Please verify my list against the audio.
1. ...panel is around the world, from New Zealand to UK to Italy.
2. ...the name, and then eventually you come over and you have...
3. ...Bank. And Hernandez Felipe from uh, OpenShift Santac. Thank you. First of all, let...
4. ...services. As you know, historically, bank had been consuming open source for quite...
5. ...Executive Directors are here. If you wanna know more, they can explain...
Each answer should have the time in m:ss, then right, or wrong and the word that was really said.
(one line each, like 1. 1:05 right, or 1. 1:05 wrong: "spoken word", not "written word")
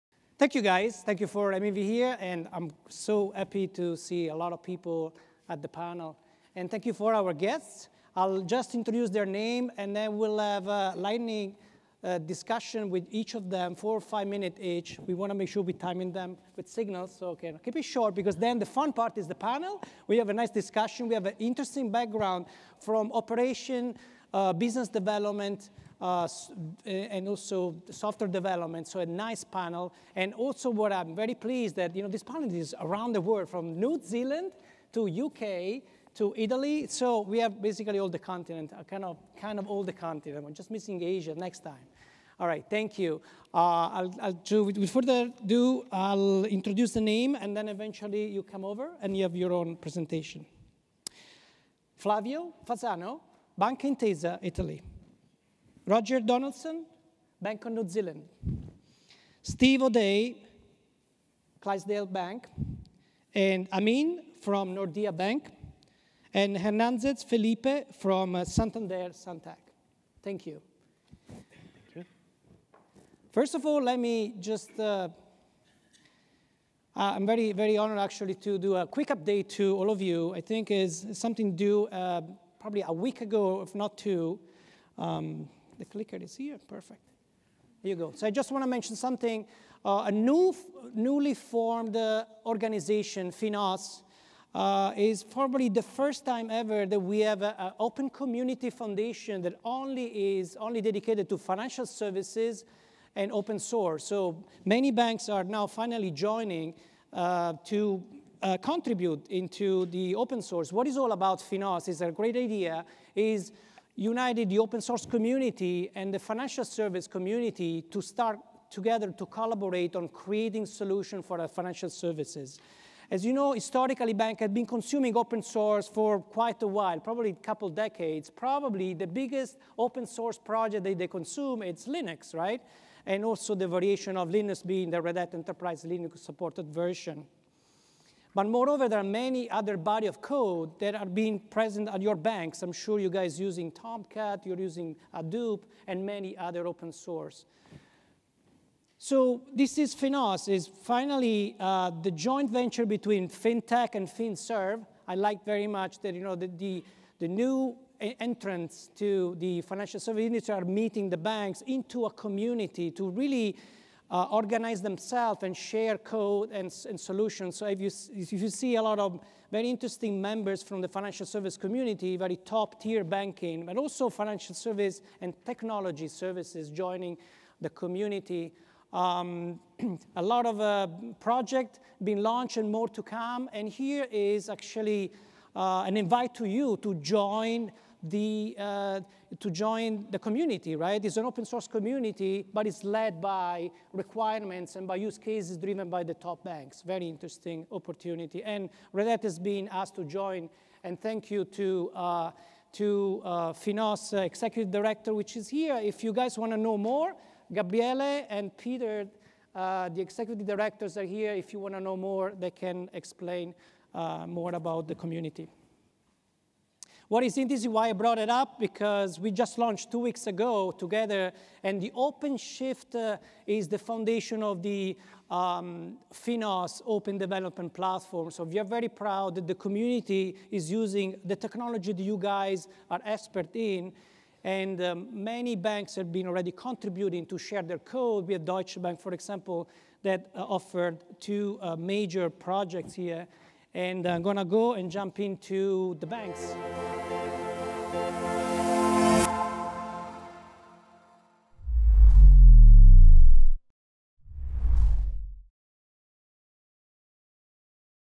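1. 0:32 right
2. 0:46 right
3. 1:05 wrong: "Santander", not "OpenShift"
4. 2:01 right
5. 3:30 right.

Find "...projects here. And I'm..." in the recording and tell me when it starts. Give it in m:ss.
4:02.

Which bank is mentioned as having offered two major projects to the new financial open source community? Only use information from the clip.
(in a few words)
Deutsche Bank.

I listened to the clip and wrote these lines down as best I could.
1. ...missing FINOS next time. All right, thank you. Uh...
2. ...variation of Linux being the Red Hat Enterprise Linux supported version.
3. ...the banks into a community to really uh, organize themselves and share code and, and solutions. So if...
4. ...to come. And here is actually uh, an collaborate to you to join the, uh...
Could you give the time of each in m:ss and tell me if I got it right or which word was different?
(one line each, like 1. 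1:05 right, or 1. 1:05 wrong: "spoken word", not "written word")
1. 0:40 wrong: "Asia", not "FINOS"
2. 2:13 right
3. 2:41 right
4. 3:02 wrong: "invite", not "collaborate".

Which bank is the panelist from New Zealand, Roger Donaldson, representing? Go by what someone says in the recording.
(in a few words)
Bank of New Zealand.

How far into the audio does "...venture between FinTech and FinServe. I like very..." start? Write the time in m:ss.
2:32.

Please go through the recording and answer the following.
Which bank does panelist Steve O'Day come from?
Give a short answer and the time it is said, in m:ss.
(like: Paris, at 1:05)
Clydesdale Bank, at 1:01.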